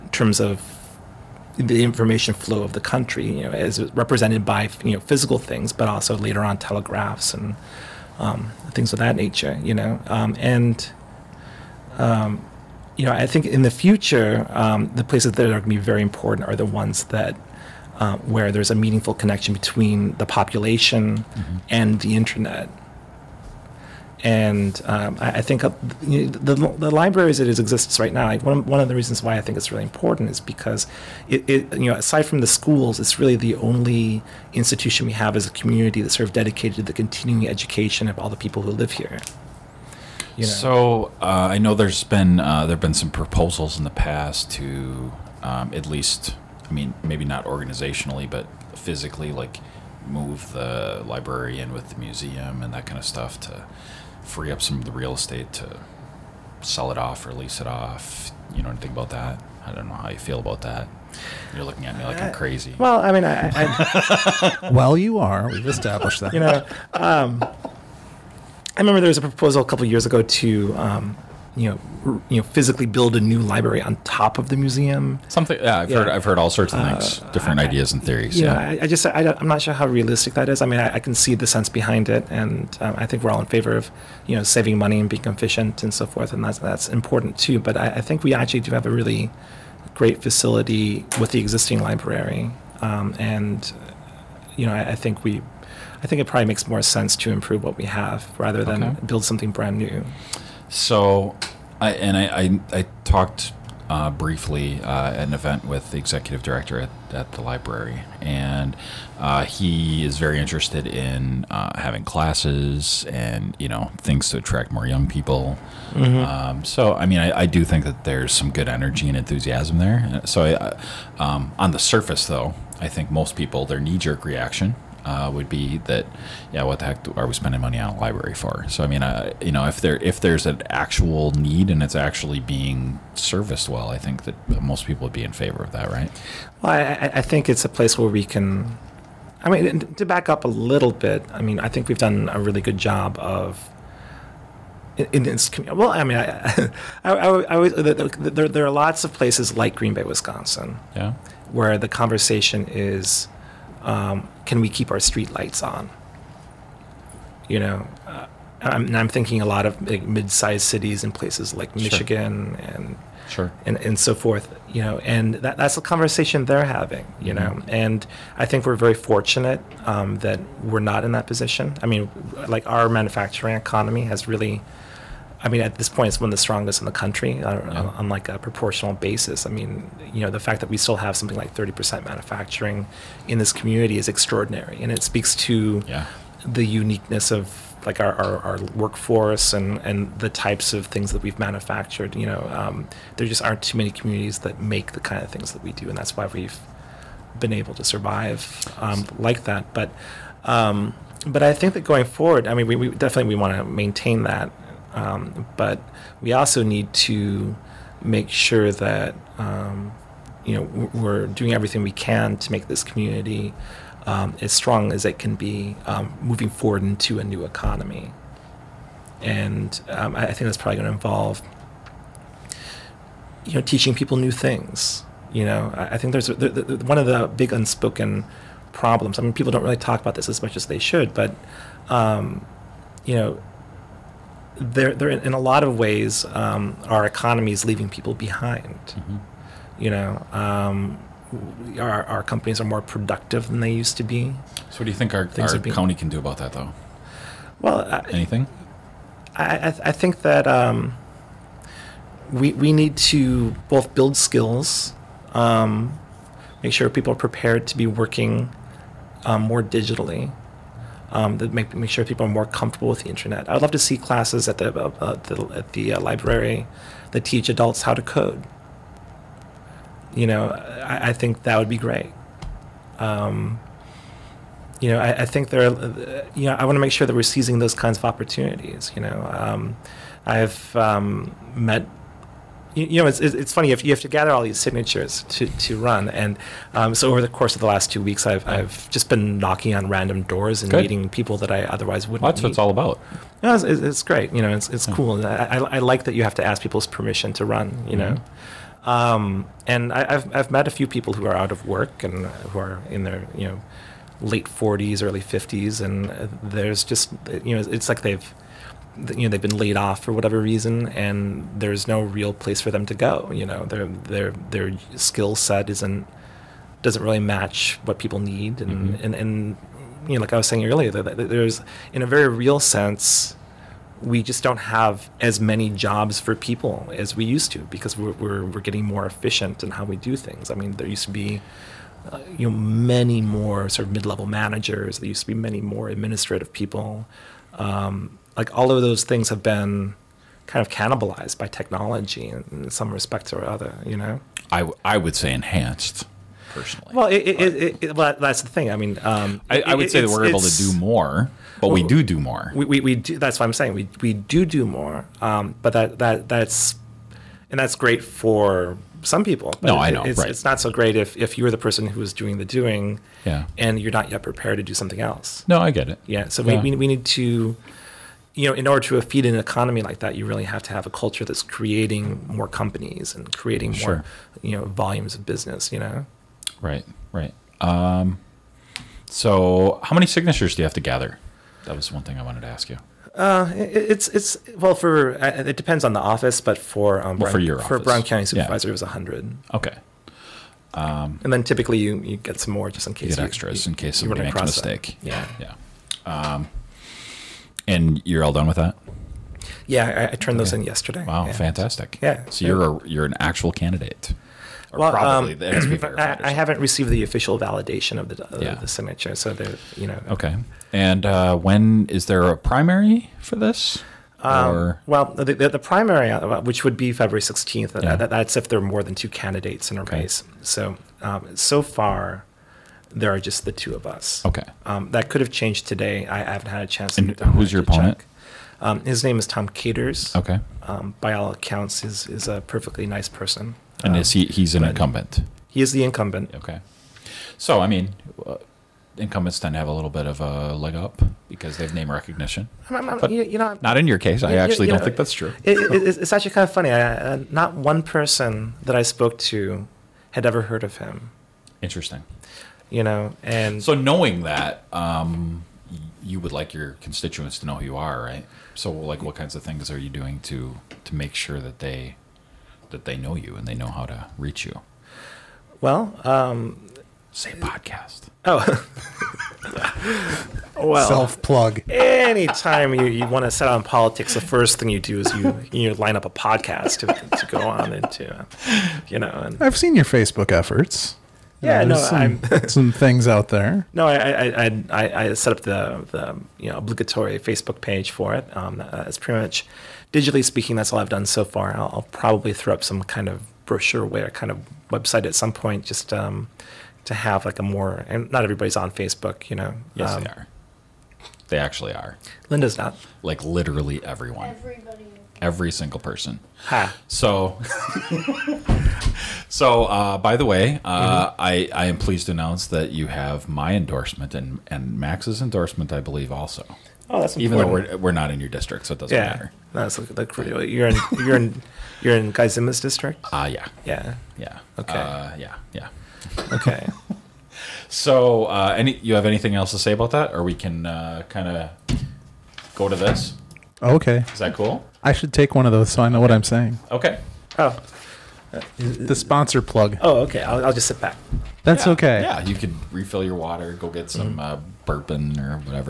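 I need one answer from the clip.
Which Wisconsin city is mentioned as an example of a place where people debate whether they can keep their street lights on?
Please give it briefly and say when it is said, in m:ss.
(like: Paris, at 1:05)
Green Bay, at 2:29.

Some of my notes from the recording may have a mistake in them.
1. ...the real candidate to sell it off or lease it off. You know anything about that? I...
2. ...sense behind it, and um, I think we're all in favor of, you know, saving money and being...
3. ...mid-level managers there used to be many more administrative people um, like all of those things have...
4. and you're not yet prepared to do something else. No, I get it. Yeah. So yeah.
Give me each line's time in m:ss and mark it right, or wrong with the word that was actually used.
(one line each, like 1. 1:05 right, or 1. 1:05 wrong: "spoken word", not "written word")
1. 0:54 wrong: "estate", not "candidate"
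2. 1:21 right
3. 5:33 right
4. 6:03 right.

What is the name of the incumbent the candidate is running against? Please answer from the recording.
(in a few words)
Tom Caters.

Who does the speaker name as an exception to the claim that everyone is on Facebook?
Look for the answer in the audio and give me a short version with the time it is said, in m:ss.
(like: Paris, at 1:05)
Linda, at 8:22.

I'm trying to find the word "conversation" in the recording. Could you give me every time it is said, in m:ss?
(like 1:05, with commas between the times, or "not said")
2:31, 2:45.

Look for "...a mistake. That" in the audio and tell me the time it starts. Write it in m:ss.
6:34.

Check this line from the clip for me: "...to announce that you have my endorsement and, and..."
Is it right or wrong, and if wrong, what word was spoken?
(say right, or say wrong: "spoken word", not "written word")
right.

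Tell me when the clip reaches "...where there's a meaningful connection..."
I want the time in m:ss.
0:18.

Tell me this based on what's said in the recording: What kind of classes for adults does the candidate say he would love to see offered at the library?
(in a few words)
how to code.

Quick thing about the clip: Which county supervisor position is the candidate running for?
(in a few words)
Brown County Supervisor.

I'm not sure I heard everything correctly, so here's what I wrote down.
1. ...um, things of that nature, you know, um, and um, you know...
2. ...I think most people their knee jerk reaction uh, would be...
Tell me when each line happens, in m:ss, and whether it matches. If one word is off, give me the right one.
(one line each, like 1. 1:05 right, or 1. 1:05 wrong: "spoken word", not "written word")
1. 0:08 right
2. 2:02 right.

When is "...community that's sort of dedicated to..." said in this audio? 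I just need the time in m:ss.
0:35.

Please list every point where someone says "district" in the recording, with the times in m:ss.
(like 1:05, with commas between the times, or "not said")
8:38, 8:42.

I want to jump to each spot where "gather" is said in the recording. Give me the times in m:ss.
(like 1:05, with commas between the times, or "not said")
4:44, 6:20.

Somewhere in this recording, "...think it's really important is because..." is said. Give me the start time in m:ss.
0:29.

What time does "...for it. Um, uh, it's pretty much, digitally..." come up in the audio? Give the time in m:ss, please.
8:07.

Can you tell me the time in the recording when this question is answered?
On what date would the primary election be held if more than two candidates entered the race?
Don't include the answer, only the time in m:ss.
6:56.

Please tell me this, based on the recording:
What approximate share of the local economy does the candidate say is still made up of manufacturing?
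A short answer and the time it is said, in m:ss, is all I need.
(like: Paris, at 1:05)
30%, at 3:01.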